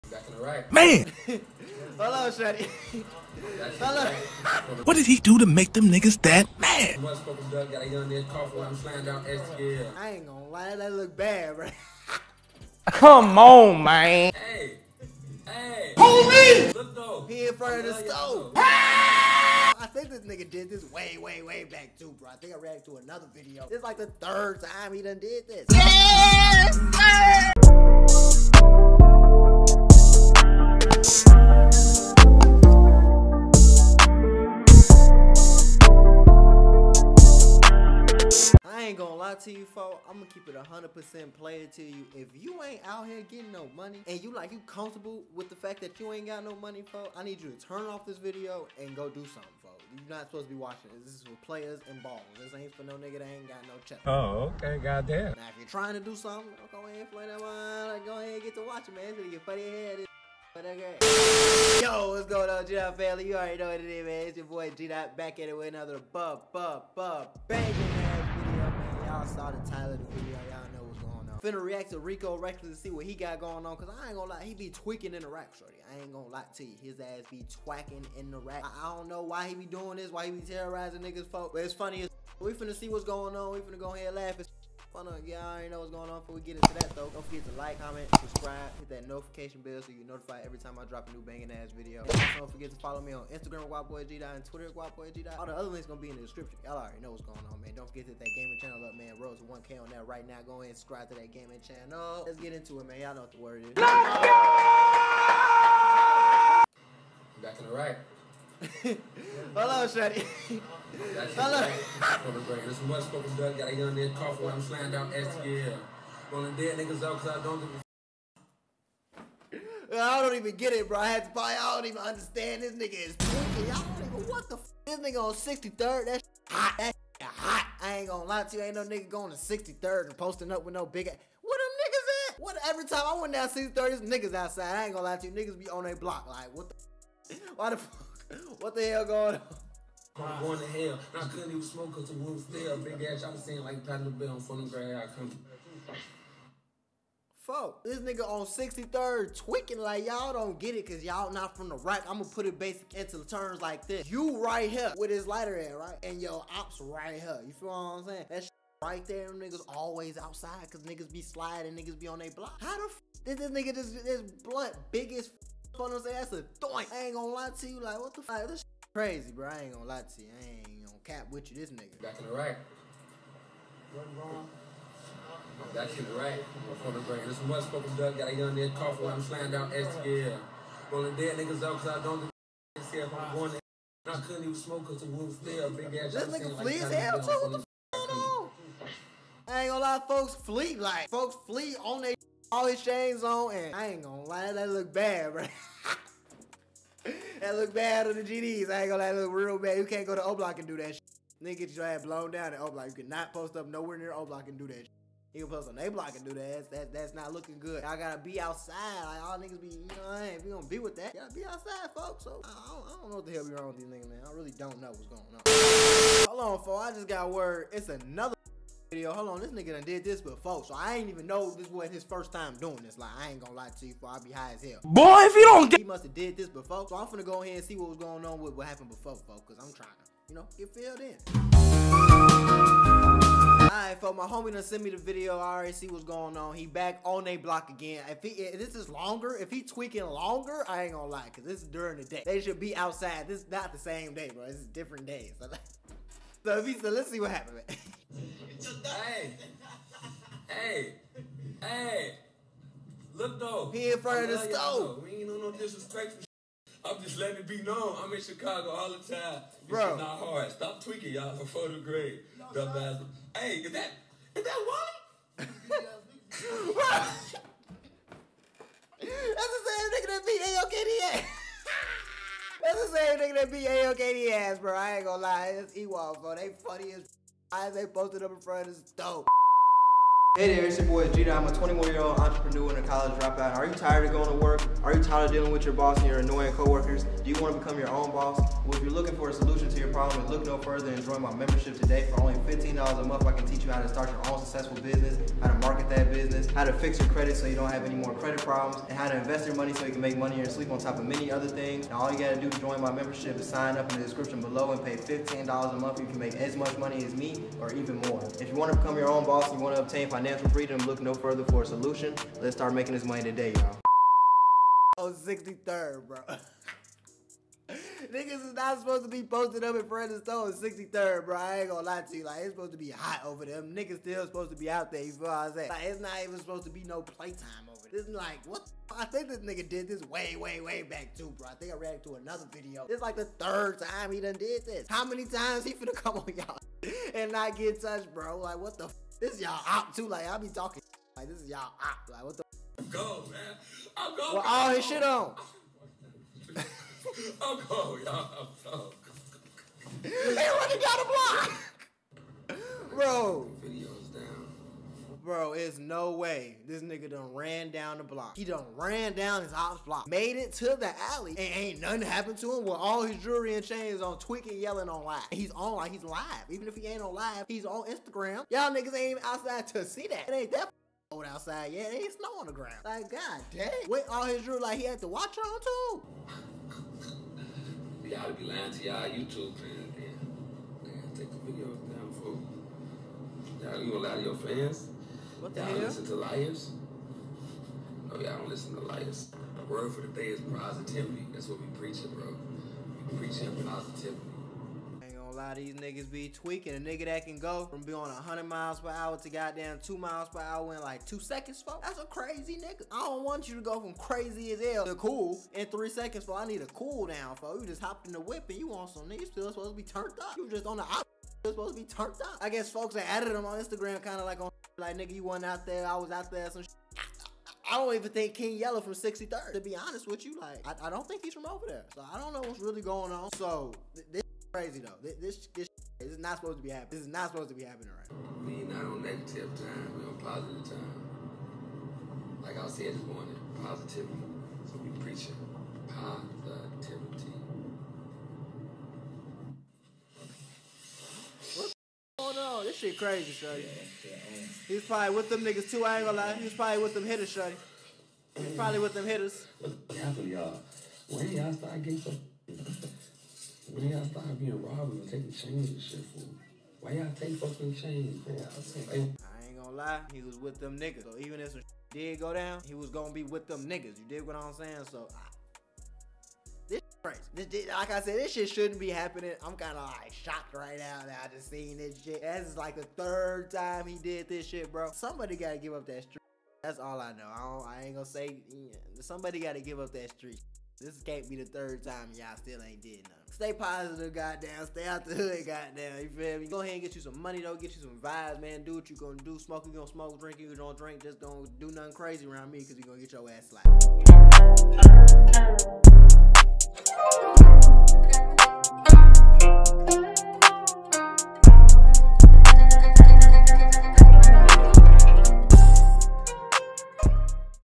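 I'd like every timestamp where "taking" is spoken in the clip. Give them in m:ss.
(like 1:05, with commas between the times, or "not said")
7:35.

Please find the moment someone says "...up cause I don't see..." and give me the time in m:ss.
3:01.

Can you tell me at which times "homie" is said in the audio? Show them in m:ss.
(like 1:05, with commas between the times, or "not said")
0:15, 3:54.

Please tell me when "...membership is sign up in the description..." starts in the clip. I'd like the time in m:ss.
5:02.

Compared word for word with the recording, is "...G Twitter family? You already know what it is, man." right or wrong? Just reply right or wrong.
wrong.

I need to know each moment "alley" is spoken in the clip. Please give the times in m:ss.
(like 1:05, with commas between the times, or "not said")
6:01.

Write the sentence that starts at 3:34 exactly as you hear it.
I really don't know what's going on.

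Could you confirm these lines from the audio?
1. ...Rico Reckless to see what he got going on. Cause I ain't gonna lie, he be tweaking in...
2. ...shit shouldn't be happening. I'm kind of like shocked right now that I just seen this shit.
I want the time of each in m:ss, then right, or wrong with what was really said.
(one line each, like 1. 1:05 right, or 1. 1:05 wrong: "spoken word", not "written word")
1. 1:11 right
2. 7:48 right.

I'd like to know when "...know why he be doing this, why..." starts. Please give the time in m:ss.
1:19.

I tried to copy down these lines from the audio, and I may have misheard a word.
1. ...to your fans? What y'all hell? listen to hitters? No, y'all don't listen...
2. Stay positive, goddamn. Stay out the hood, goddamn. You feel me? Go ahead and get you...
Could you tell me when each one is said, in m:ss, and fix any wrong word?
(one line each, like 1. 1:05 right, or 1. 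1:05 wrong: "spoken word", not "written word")
1. 6:24 wrong: "liars", not "hitters"
2. 8:03 right.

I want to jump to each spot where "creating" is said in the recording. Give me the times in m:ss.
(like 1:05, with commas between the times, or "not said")
not said.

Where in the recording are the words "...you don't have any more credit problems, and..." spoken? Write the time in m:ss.
4:57.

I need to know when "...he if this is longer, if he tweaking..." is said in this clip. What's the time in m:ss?
3:58.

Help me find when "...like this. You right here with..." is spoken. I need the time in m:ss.
2:33.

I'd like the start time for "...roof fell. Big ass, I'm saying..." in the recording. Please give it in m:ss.
2:22.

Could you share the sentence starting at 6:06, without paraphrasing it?
Even if he ain't on live, he's on Instagram.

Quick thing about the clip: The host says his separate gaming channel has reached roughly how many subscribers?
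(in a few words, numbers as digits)
1K.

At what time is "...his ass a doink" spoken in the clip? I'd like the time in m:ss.
2:45.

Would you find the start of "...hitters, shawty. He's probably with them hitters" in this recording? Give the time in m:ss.
7:27.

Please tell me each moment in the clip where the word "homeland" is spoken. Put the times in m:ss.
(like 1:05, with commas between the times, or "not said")
not said.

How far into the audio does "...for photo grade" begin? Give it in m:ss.
4:21.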